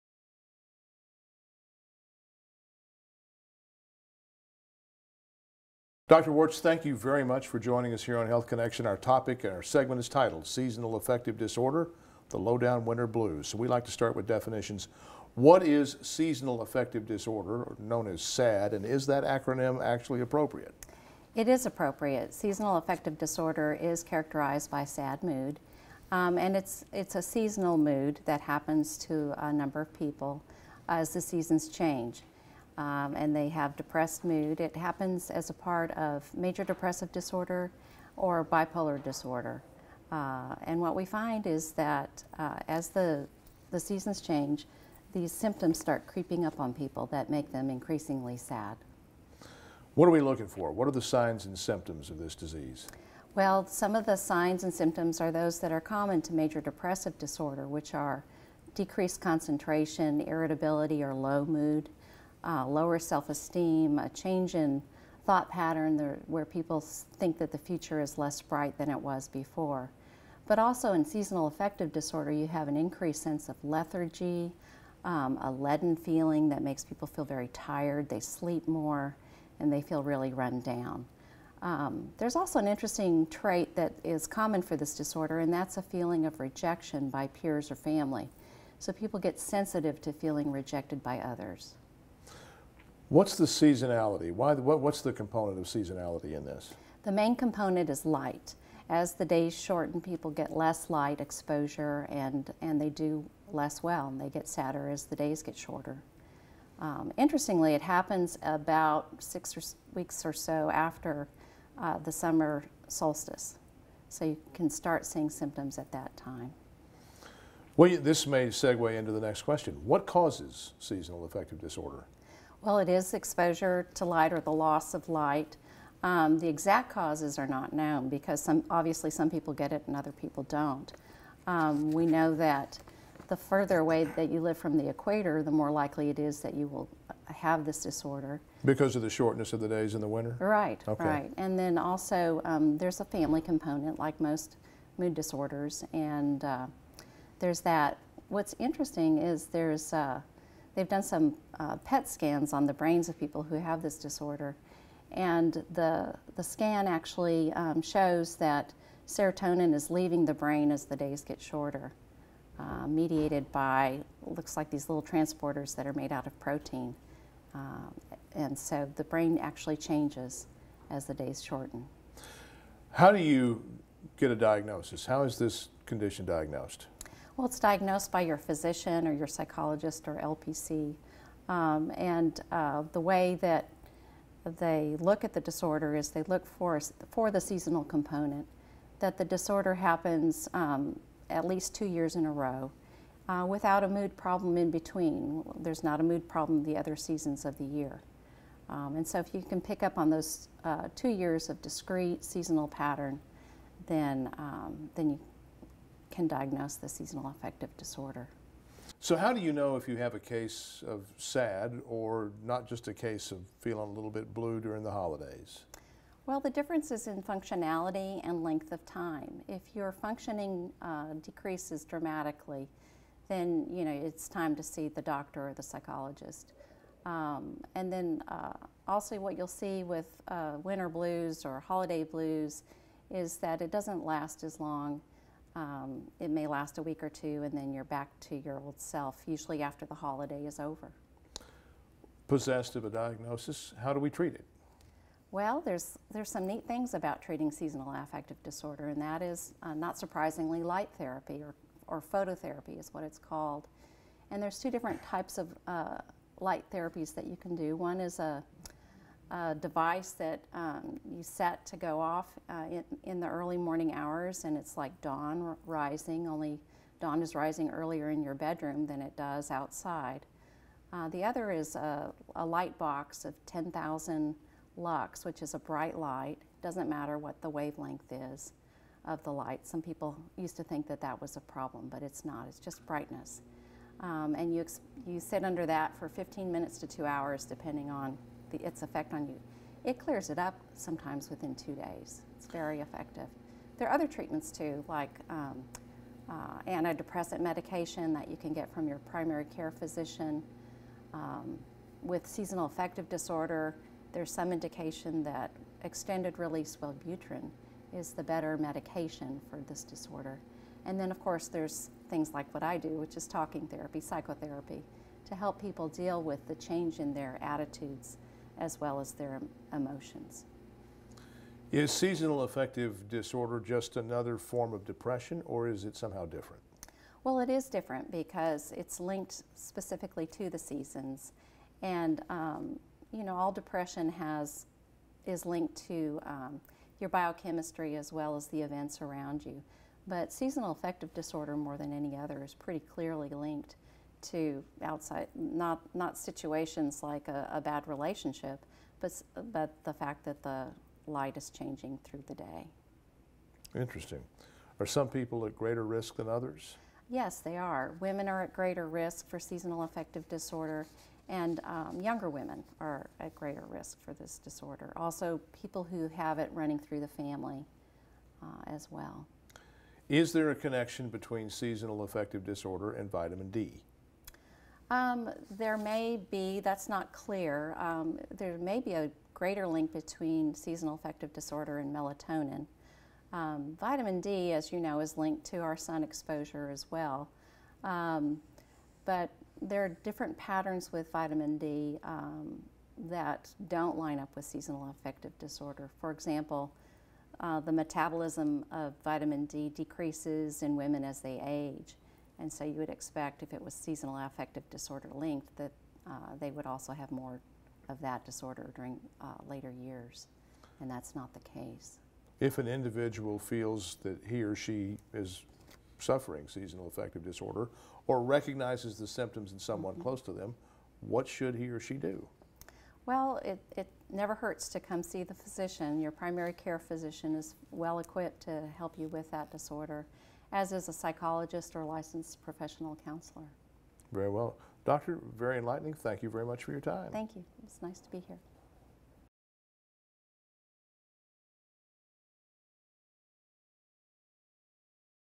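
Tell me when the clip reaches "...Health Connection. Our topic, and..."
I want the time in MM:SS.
00:08.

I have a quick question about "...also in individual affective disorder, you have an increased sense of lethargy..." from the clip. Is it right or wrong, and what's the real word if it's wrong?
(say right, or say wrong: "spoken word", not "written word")
wrong: "seasonal", not "individual".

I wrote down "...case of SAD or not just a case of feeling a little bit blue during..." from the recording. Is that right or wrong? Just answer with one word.
right.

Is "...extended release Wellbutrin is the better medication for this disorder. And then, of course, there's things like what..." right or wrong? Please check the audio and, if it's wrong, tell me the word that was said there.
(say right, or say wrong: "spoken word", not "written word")
right.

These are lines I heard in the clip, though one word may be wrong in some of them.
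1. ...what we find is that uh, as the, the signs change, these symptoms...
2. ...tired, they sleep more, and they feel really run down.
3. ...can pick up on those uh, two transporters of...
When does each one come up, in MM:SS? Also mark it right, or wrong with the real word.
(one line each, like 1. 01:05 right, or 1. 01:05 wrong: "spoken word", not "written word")
1. 00:40 wrong: "seasons", not "signs"
2. 01:17 right
3. 03:19 wrong: "years", not "transporters".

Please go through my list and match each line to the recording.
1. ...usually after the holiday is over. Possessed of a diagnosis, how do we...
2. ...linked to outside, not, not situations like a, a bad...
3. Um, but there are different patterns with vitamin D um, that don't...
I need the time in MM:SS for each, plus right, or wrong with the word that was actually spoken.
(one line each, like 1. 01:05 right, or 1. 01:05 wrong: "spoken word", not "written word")
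1. 03:59 right
2. 05:43 right
3. 06:27 right.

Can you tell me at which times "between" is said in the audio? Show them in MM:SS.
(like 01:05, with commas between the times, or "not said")
03:14, 06:11, 06:19.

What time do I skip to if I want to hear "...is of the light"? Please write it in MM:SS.
04:38.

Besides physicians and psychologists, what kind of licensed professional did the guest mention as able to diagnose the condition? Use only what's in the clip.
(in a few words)
LPC.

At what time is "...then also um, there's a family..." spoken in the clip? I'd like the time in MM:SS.
02:21.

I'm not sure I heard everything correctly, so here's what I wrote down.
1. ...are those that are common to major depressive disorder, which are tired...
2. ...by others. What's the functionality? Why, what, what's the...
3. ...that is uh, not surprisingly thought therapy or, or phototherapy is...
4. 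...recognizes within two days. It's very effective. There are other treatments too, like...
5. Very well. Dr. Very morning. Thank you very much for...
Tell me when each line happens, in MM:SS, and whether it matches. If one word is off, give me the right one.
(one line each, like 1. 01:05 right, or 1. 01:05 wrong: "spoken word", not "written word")
1. 00:55 wrong: "decreased", not "tired"
2. 01:31 wrong: "seasonality", not "functionality"
3. 04:09 wrong: "light", not "thought"
4. 04:50 wrong: "sometimes", not "recognizes"
5. 07:14 wrong: "enlightening", not "morning".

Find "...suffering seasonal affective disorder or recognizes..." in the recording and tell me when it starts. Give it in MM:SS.
06:55.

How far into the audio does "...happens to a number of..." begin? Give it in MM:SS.
00:28.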